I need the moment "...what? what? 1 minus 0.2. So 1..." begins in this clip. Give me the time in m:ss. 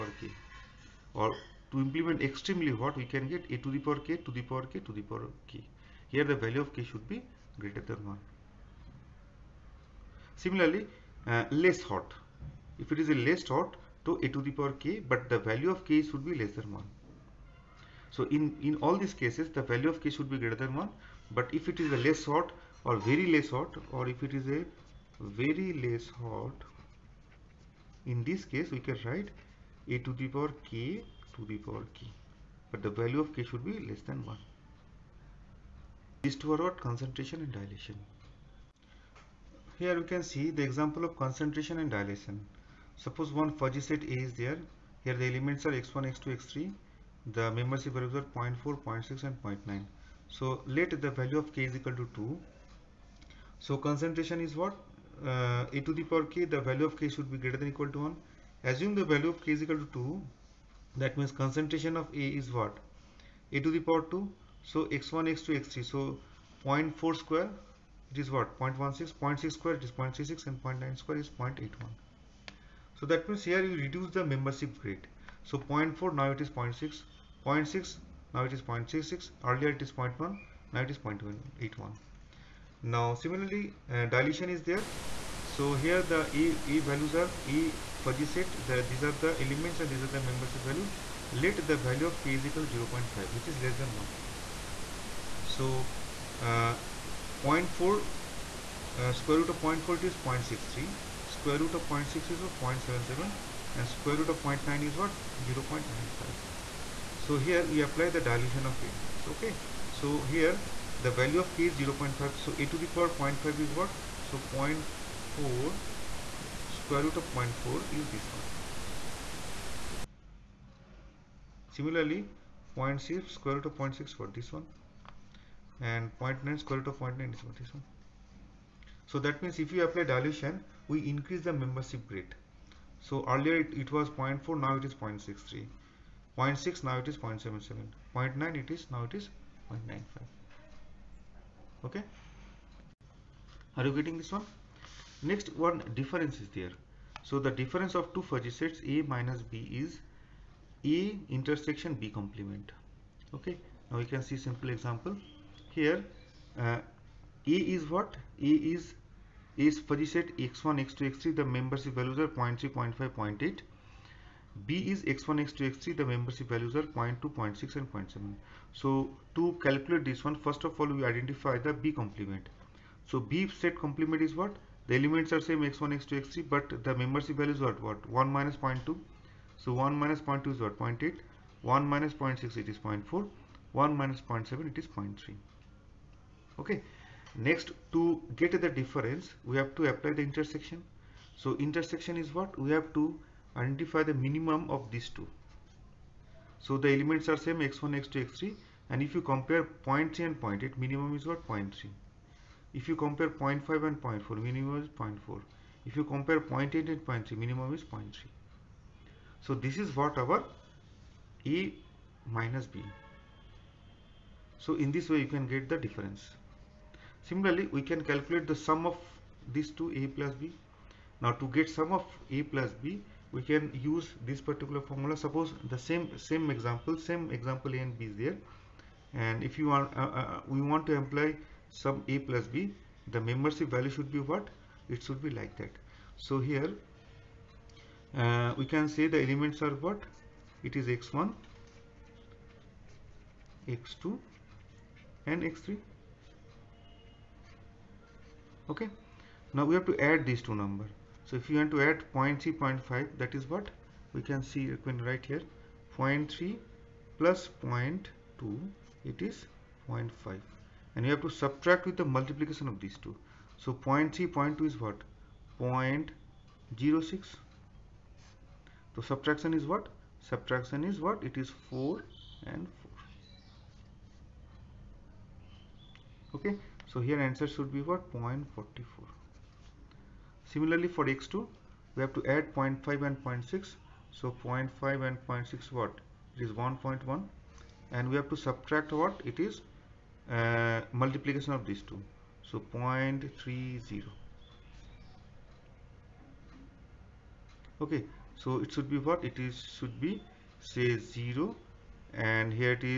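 2:57.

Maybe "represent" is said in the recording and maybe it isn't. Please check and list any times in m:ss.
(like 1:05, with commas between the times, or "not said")
not said.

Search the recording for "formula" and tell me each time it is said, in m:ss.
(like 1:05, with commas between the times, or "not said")
3:44.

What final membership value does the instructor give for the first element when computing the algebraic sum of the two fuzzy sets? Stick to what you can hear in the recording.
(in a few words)
0.44.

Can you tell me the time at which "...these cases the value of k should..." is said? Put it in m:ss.
0:19.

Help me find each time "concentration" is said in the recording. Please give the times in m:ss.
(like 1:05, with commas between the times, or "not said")
0:36, 0:41, 0:53, 1:01.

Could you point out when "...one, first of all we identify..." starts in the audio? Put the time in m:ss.
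2:50.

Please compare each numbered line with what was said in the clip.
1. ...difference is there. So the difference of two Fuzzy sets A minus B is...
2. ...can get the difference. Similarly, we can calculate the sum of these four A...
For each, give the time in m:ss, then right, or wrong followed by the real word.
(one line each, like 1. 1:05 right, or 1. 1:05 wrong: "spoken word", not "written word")
1. 2:25 right
2. 3:35 wrong: "two", not "four".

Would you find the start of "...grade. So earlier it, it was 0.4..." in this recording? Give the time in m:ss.
2:12.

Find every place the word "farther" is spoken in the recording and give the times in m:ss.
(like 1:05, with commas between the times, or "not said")
not said.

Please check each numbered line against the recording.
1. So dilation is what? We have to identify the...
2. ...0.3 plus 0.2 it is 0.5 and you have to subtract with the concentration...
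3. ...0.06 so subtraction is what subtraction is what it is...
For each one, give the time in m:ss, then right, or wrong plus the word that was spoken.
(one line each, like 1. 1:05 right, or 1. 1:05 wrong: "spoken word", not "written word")
1. 3:11 wrong: "intersection", not "dilation"
2. 4:15 wrong: "multiplication", not "concentration"
3. 4:25 right.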